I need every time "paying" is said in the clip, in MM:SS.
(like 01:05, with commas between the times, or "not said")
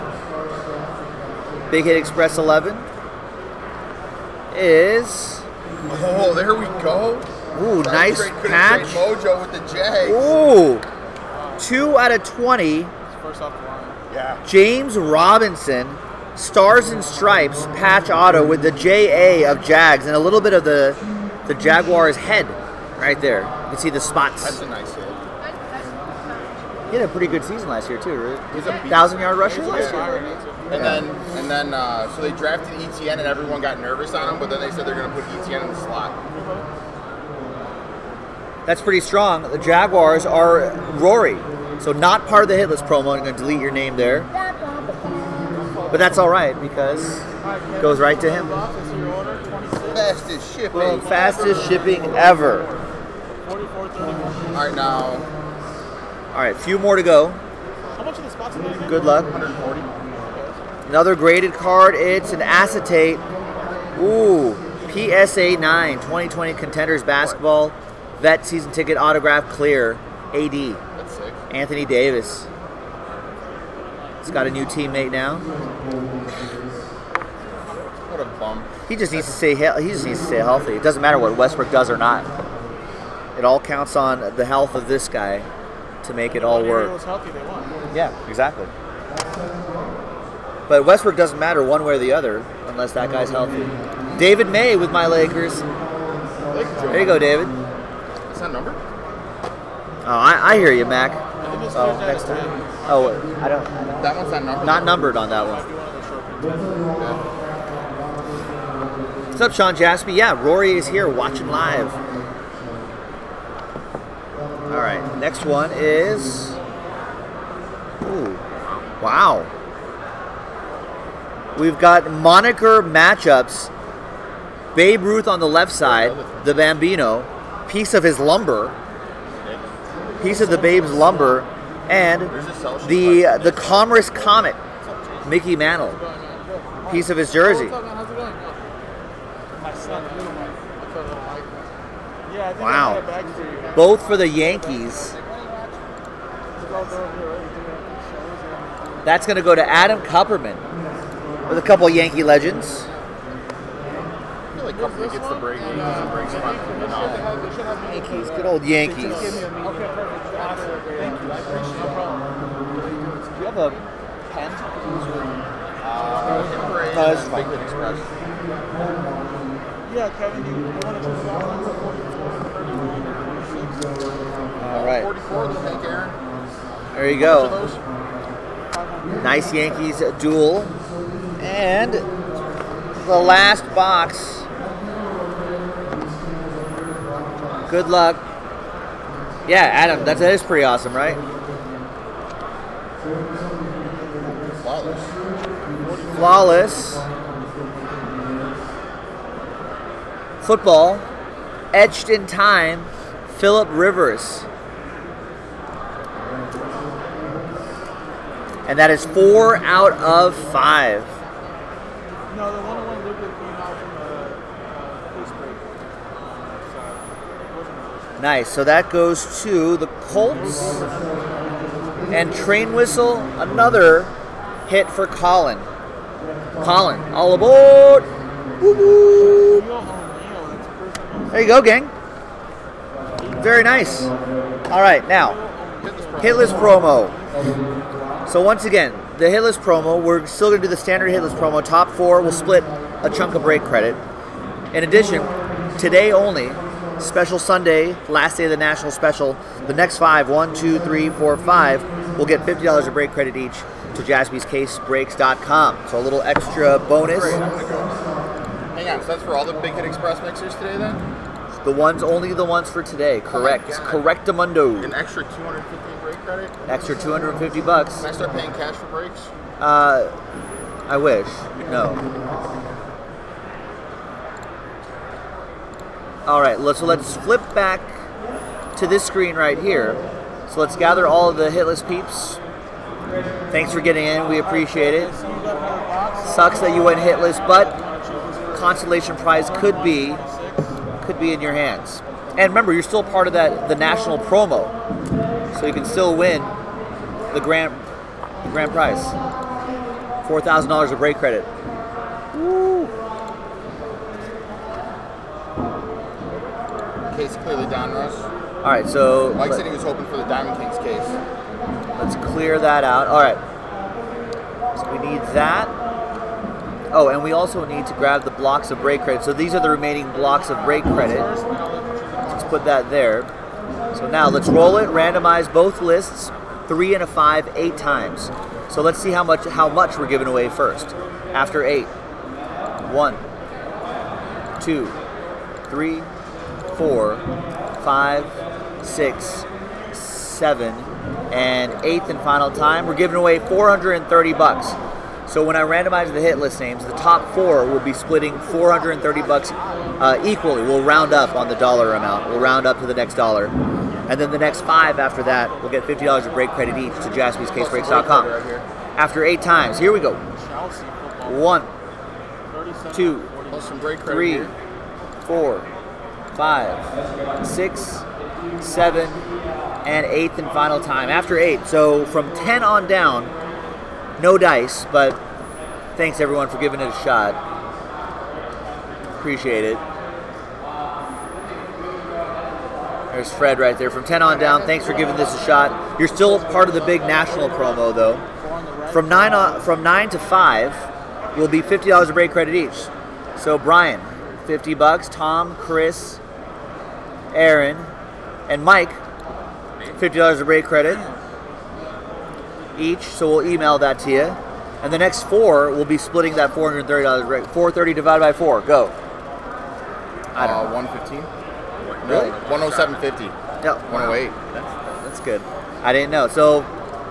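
04:28.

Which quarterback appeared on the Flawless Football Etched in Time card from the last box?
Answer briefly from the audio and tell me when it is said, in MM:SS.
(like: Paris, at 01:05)
Philip Rivers, at 03:23.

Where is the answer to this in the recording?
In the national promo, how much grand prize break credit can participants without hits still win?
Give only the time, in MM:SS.
05:00.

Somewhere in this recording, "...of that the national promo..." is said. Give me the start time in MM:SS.
04:53.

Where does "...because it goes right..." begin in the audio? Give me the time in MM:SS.
00:46.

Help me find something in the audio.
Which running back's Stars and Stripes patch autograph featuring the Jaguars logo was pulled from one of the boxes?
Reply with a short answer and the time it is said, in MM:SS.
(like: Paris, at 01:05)
James Robinson, at 00:14.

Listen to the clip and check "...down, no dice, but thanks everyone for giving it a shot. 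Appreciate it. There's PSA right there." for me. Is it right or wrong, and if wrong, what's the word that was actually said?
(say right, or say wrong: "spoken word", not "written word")
wrong: "Fred", not "PSA".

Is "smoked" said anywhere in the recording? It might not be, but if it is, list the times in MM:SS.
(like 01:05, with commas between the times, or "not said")
not said.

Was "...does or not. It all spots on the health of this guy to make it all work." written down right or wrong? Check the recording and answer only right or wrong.
wrong.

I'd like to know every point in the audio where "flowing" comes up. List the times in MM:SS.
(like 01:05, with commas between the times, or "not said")
not said.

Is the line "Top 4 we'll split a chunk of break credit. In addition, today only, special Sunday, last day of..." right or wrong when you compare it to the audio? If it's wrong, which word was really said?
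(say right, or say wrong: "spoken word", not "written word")
right.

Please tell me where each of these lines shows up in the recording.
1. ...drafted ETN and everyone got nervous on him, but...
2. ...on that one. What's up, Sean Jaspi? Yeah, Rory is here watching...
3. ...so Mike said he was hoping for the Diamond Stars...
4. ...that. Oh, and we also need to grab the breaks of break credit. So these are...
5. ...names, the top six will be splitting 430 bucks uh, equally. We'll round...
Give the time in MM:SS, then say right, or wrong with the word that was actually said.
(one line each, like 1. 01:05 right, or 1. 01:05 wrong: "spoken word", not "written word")
1. 00:32 right
2. 01:45 right
3. 05:08 wrong: "Kings", not "Stars"
4. 05:15 wrong: "blocks", not "breaks"
5. 05:46 wrong: "four", not "six".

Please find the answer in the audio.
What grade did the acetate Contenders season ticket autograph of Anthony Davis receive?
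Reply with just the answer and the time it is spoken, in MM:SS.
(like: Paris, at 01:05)
PSA 9, at 01:04.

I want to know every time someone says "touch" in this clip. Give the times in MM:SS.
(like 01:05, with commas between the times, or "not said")
not said.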